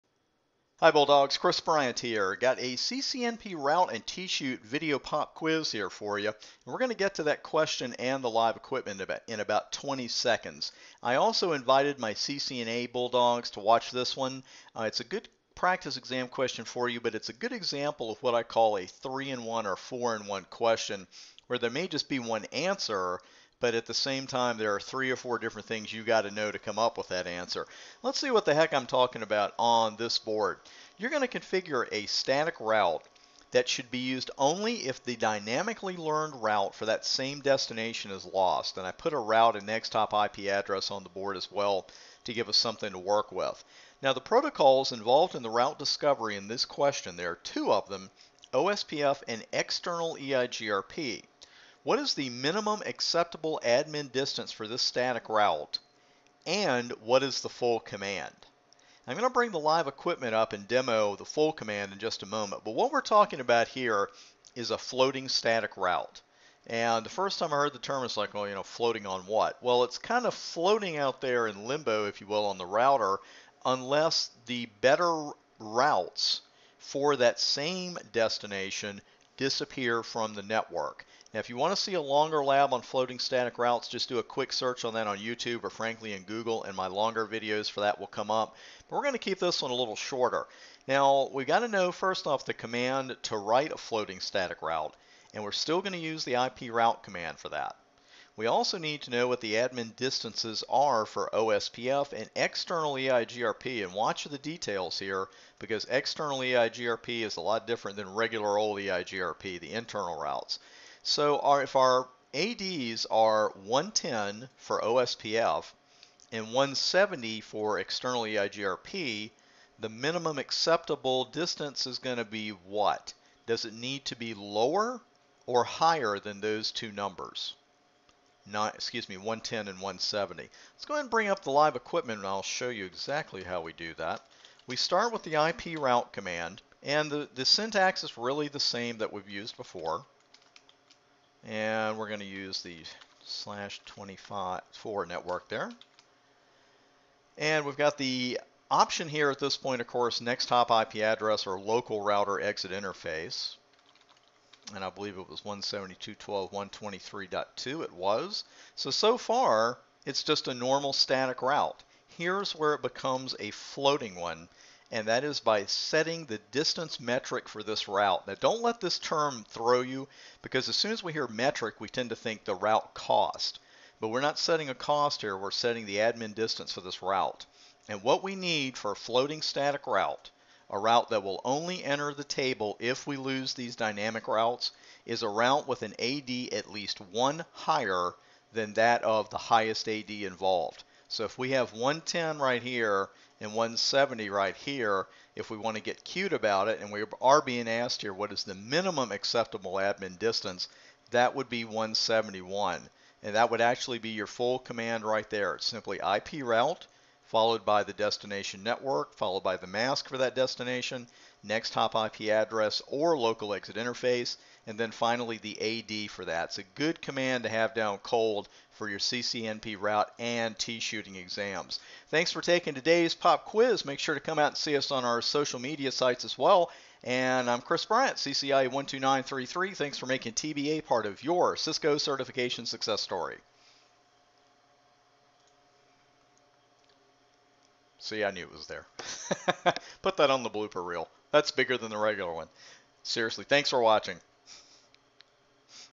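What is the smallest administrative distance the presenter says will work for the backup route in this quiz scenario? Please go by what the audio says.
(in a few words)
171.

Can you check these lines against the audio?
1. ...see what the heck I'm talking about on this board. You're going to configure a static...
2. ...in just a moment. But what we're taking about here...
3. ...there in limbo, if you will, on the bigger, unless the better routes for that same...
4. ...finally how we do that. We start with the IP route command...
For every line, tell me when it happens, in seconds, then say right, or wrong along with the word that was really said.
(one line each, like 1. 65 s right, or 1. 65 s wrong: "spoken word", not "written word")
1. 28 s right
2. 61 s wrong: "talking", not "taking"
3. 71 s wrong: "router", not "bigger"
4. 132 s wrong: "exactly", not "finally".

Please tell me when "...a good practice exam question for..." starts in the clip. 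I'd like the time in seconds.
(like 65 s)
15 s.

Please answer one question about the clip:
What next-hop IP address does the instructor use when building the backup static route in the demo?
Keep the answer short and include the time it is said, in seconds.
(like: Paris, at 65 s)
172.12.123.2, at 155 s.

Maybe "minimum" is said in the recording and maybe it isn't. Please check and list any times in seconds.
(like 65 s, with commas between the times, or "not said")
52 s, 119 s, 198 s.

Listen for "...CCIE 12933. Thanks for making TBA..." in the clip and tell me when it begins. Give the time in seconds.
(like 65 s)
228 s.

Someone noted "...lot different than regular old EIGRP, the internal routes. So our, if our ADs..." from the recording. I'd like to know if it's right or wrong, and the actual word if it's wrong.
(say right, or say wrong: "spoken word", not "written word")
right.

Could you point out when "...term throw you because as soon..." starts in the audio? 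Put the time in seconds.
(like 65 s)
168 s.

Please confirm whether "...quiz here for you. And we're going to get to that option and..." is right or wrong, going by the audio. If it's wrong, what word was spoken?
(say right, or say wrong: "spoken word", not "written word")
wrong: "question", not "option".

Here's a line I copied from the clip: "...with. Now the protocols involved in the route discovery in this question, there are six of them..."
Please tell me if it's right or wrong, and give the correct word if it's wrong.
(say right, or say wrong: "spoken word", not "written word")
wrong: "two", not "six".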